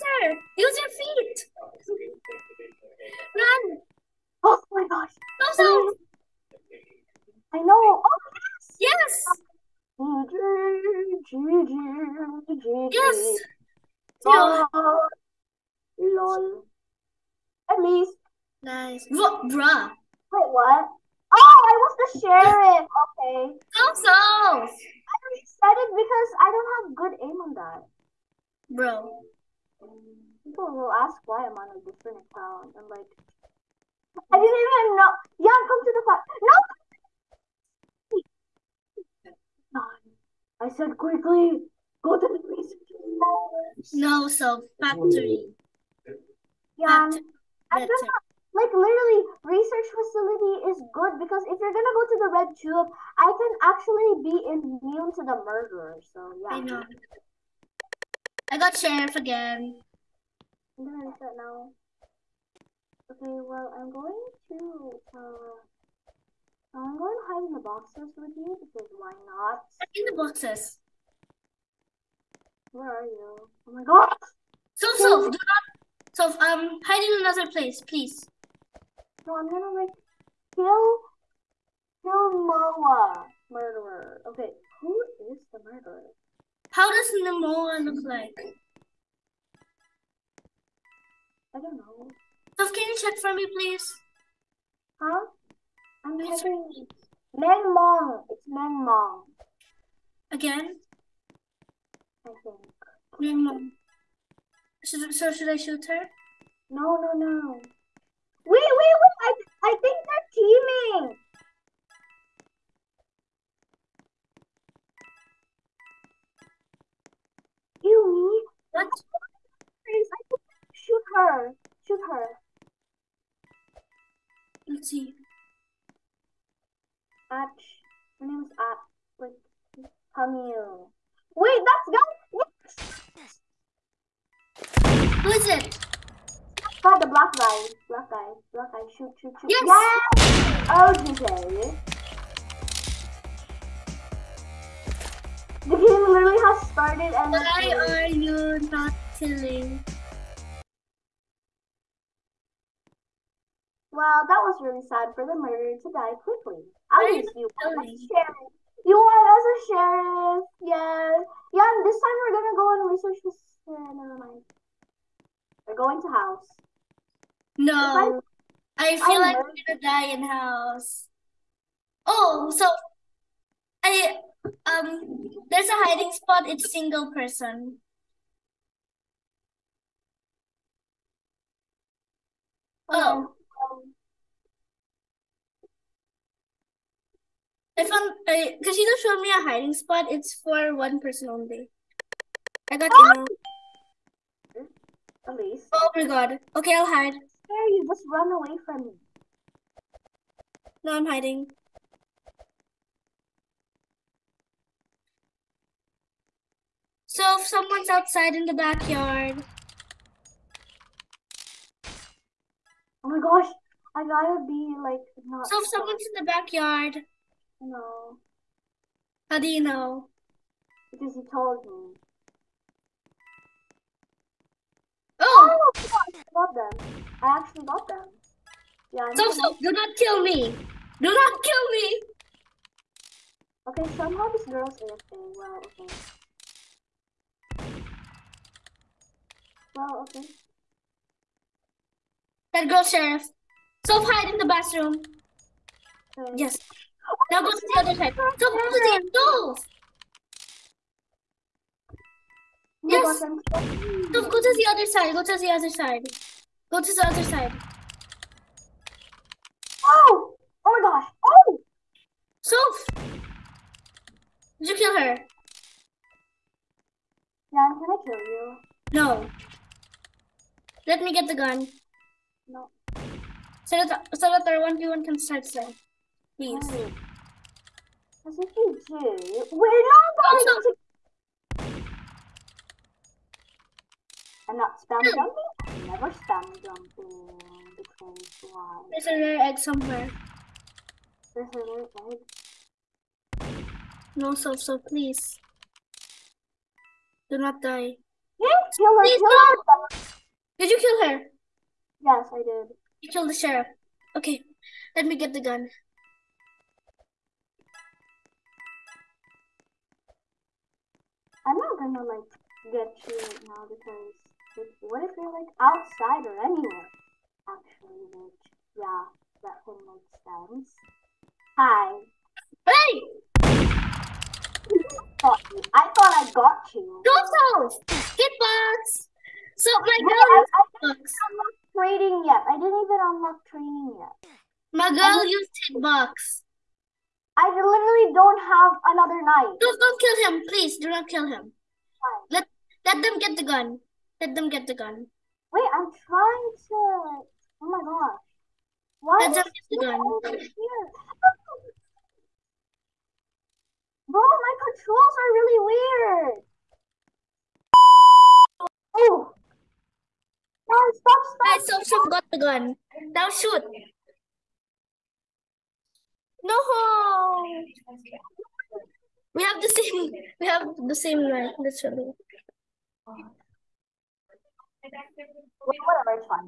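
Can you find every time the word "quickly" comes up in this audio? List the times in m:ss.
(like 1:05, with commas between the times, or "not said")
0:40, 2:36.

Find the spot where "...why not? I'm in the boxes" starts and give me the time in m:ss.
1:08.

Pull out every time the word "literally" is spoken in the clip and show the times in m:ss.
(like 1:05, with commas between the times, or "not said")
0:48, 2:26, 5:37, 6:11.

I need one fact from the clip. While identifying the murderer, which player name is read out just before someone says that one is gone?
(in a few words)
Camille.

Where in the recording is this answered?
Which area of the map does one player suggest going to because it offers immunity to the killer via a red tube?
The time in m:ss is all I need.
0:49.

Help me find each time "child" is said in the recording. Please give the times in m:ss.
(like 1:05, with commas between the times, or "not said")
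not said.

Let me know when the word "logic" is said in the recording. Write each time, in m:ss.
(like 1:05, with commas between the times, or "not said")
not said.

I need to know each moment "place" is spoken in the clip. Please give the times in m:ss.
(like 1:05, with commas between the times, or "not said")
1:17.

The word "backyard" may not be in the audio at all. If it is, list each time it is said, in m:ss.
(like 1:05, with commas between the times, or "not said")
3:28, 3:36.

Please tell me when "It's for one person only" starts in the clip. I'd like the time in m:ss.
3:10.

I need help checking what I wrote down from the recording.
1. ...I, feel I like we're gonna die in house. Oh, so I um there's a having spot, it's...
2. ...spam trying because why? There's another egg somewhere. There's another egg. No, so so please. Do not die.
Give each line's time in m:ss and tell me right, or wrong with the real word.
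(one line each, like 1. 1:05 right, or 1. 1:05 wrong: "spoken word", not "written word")
1. 2:48 wrong: "hiding", not "having"
2. 4:46 wrong: "jumping", not "trying".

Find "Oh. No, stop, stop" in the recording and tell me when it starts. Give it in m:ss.
5:58.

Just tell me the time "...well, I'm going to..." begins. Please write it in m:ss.
1:03.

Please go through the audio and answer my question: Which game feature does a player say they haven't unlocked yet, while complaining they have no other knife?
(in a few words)
Trading.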